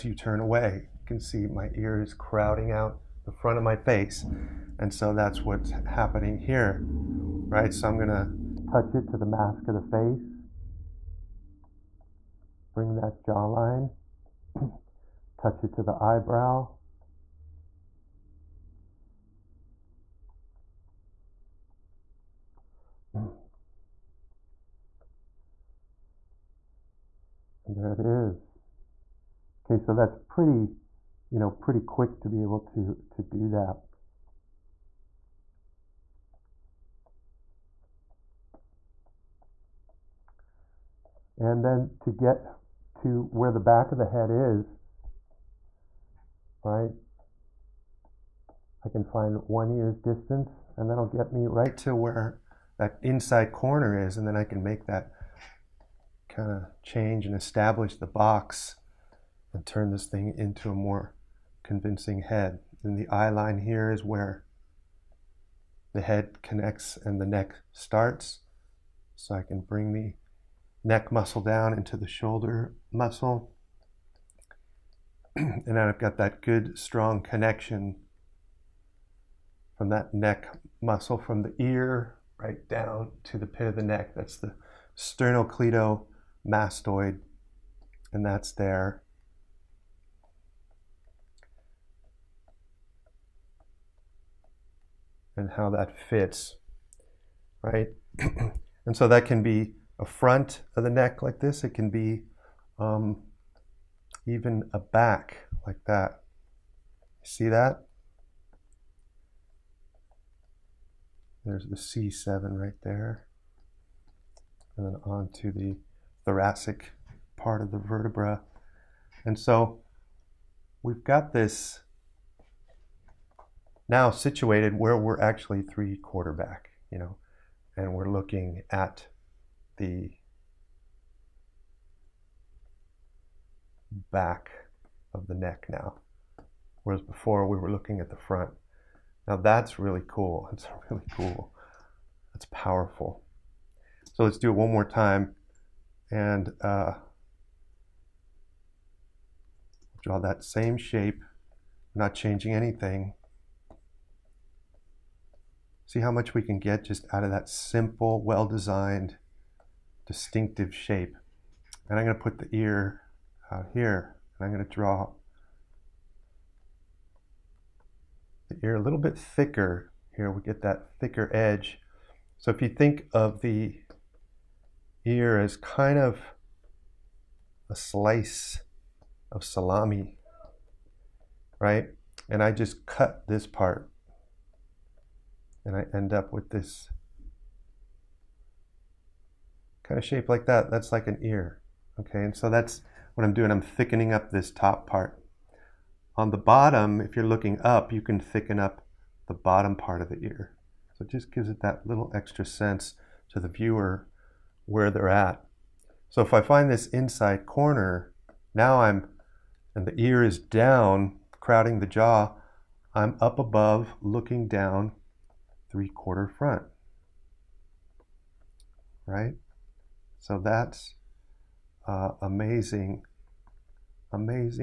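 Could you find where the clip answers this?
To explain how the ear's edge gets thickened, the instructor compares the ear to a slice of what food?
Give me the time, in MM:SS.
02:59.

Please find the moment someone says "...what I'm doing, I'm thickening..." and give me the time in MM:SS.
03:13.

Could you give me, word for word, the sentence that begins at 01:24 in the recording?
That's the sternocleidomastoid, and that's there.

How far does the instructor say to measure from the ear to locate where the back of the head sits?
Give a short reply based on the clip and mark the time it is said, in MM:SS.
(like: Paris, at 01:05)
one ear's distance, at 00:49.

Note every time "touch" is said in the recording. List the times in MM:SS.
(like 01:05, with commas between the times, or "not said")
00:08, 00:15.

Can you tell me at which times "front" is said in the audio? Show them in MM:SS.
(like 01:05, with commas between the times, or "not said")
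00:03, 01:40, 02:18, 03:36.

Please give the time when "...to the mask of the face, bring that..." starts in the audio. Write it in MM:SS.
00:09.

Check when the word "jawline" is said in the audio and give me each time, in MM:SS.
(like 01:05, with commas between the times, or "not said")
00:13.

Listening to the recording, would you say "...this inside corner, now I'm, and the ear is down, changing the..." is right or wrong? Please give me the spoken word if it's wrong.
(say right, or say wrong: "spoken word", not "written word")
wrong: "crowding", not "changing".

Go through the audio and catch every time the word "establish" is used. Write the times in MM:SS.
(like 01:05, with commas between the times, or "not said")
00:57.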